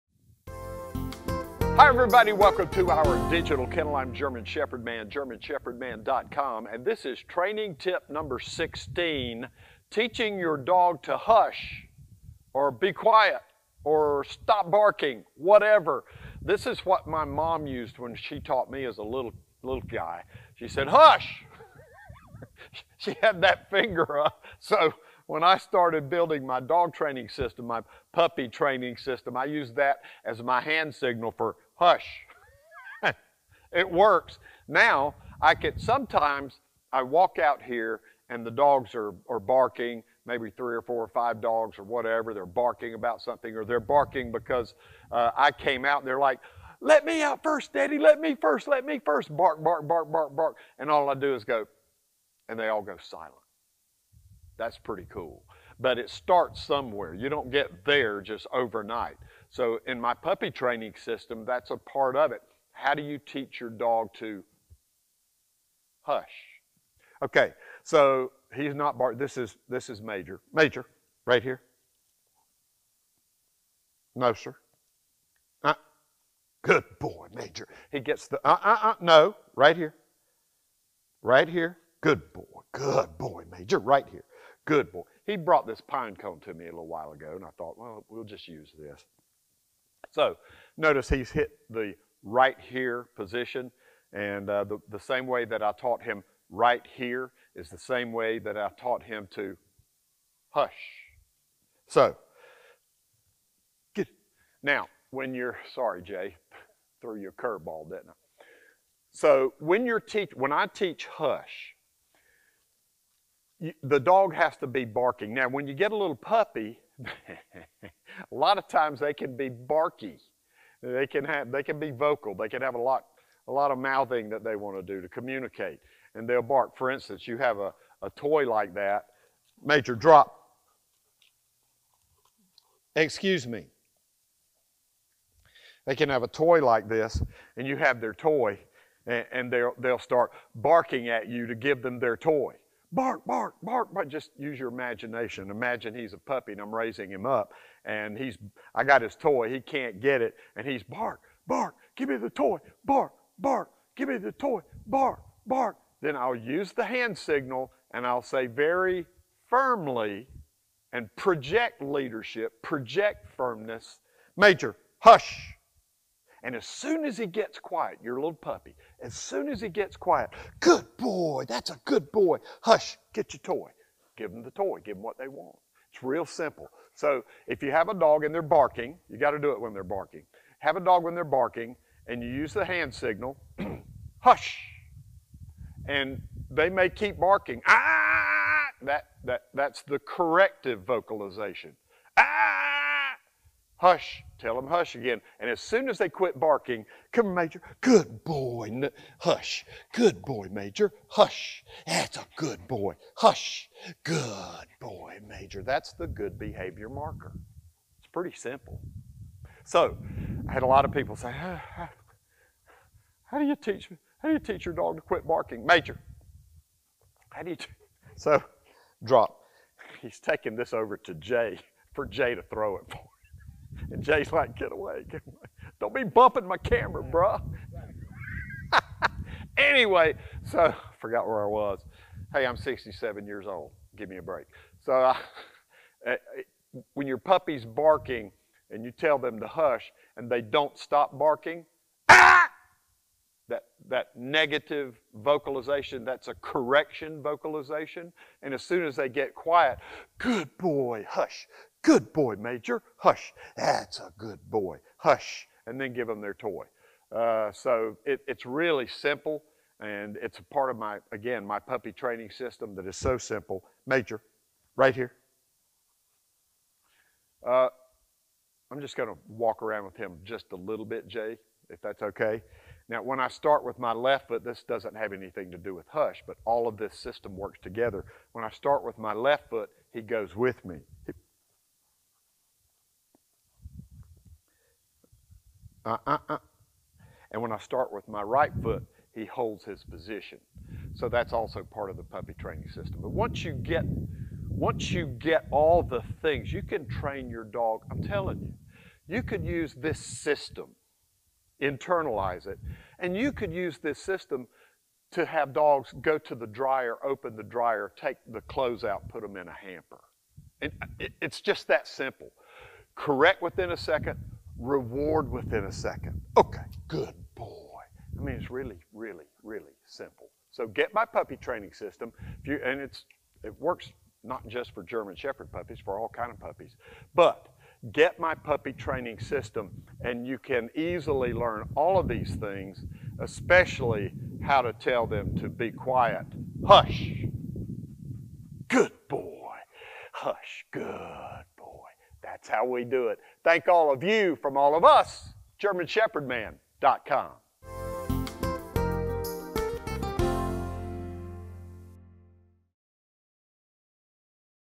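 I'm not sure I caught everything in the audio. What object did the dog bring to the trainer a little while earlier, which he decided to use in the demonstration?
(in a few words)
Pine cone.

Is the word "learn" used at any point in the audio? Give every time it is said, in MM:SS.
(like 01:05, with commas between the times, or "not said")
05:31.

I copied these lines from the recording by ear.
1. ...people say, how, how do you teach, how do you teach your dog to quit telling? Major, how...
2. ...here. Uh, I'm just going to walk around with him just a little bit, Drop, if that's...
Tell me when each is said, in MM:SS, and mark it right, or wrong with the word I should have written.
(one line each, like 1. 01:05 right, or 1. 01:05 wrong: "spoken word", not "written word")
1. 03:30 wrong: "barking", not "telling"
2. 04:24 wrong: "Jay", not "Drop".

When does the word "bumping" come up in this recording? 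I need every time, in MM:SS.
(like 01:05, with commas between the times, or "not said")
03:46.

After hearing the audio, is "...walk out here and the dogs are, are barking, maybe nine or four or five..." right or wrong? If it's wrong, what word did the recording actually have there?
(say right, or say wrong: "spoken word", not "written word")
wrong: "three", not "nine".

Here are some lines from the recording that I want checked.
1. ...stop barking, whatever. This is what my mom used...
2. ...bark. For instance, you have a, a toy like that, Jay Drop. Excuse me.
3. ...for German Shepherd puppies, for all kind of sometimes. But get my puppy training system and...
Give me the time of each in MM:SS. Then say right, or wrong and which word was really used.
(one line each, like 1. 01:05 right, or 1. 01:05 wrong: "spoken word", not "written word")
1. 00:14 right
2. 02:06 wrong: "Major", not "Jay"
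3. 05:24 wrong: "puppies", not "sometimes".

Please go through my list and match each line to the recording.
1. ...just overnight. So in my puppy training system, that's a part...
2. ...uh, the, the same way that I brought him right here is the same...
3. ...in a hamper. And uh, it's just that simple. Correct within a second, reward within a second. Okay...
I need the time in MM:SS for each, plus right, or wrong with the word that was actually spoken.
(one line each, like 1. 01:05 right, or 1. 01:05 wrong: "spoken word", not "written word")
1. 00:58 right
2. 01:34 wrong: "taught", not "brought"
3. 05:09 right.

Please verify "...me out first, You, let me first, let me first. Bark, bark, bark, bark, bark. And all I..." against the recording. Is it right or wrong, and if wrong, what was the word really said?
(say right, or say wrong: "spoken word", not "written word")
wrong: "Daddy", not "You".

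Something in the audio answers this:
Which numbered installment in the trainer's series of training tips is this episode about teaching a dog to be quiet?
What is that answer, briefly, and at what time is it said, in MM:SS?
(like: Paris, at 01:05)
16, at 00:08.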